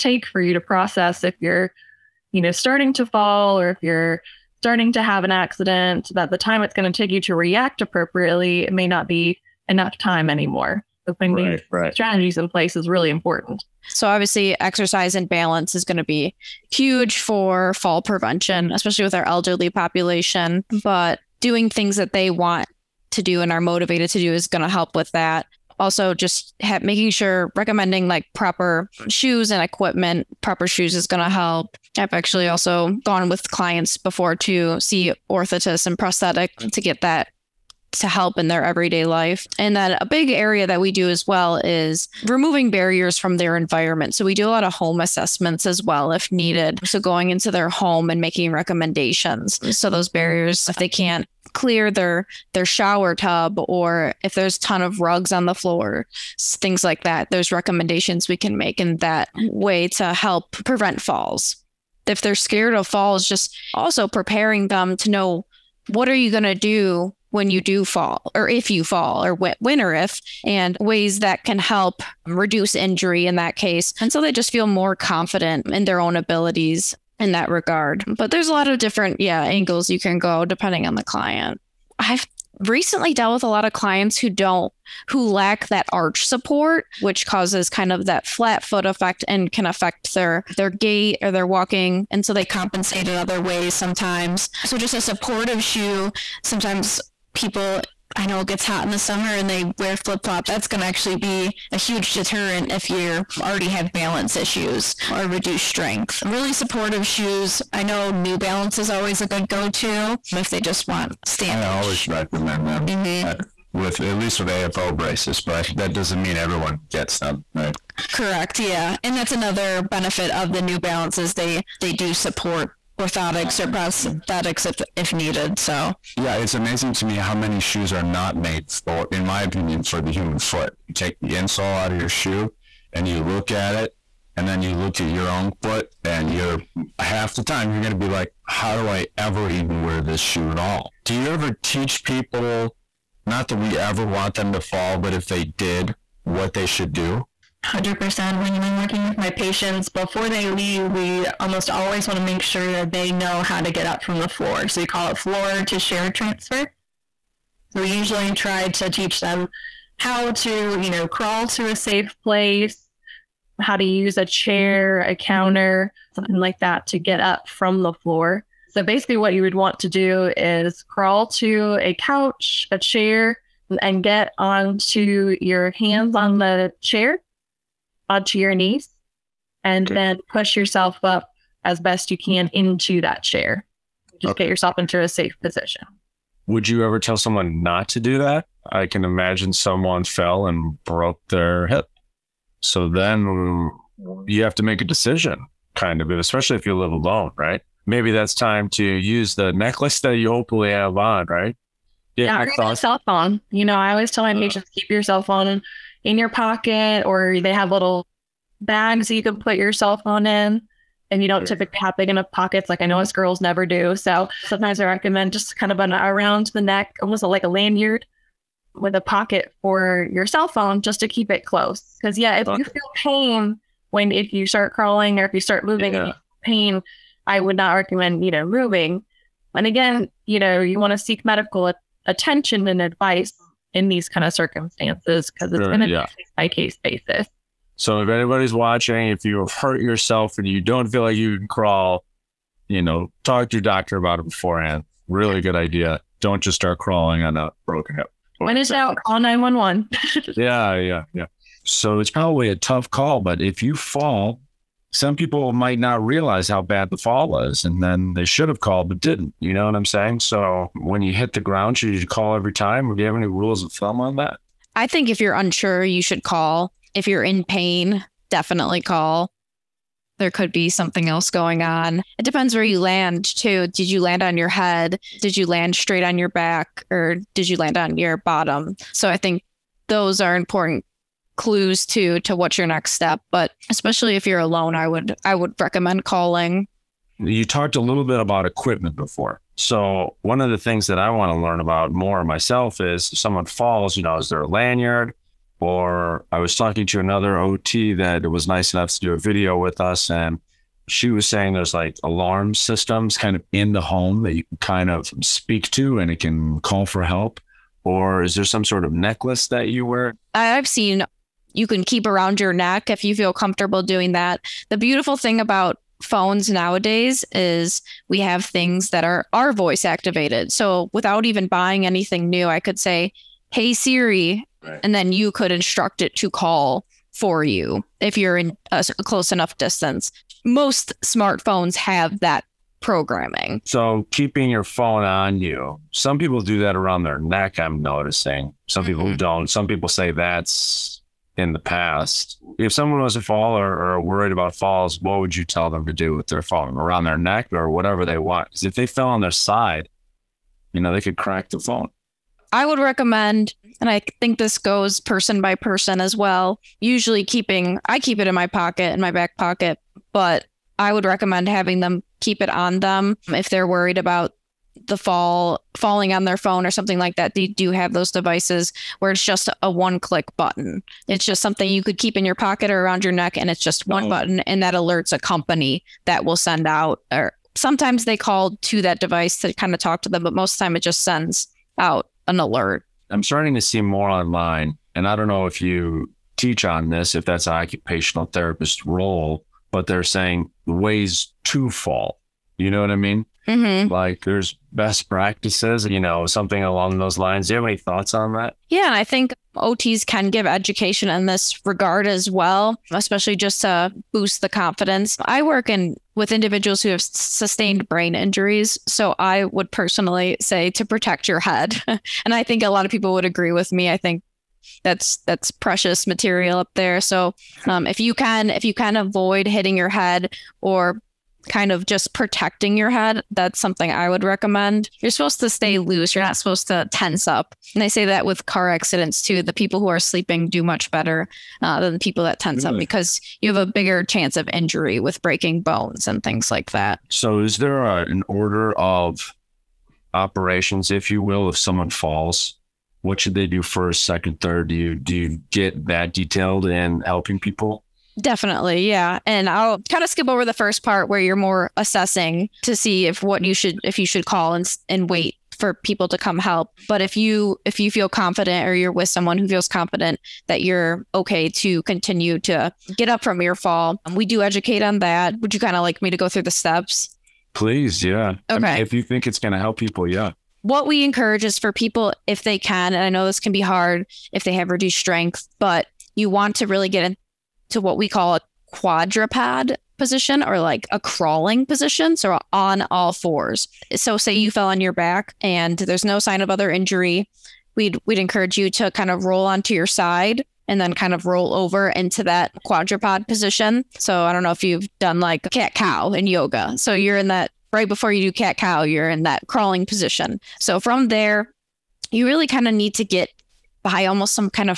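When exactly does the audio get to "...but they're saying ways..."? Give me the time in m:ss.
6:29.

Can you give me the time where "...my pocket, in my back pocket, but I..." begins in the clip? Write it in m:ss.
5:58.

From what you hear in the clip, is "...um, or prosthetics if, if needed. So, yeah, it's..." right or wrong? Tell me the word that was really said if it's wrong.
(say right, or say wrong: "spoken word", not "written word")
right.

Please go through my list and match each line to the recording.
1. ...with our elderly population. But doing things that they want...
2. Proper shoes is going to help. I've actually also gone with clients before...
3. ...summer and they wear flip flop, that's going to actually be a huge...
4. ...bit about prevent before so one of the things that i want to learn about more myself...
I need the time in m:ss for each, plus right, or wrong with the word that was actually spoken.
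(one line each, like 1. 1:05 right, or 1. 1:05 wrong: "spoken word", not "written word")
1. 0:19 right
2. 0:30 right
3. 1:39 right
4. 4:48 wrong: "equipment", not "prevent".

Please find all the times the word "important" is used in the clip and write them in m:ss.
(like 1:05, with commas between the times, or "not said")
0:13, 4:40.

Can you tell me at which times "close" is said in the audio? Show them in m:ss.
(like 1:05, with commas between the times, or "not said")
3:41, 5:29.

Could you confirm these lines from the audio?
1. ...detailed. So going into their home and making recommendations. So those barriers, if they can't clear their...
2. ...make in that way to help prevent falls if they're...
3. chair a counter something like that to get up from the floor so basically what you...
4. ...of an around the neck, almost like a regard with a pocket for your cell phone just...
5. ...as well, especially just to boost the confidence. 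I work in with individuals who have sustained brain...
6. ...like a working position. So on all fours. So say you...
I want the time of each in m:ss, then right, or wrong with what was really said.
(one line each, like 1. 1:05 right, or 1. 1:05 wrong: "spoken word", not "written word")
1. 0:46 wrong: "needed", not "detailed"
2. 0:58 right
3. 2:44 right
4. 3:35 wrong: "lanyard", not "regard"
5. 6:42 right
6. 8:00 wrong: "crawling", not "working".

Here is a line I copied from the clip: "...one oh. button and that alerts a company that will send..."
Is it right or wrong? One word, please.
right.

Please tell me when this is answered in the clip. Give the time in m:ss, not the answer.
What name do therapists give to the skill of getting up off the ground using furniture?
2:35.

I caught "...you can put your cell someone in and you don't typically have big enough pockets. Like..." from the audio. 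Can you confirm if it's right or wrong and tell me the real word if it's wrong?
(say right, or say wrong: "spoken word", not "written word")
wrong: "phone", not "someone".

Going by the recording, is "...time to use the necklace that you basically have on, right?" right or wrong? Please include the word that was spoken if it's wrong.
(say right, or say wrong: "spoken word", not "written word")
wrong: "hopefully", not "basically".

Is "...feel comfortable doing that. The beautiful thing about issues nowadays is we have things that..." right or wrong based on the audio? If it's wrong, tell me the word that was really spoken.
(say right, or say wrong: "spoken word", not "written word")
wrong: "phones", not "issues".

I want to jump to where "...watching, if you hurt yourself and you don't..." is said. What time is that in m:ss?
3:58.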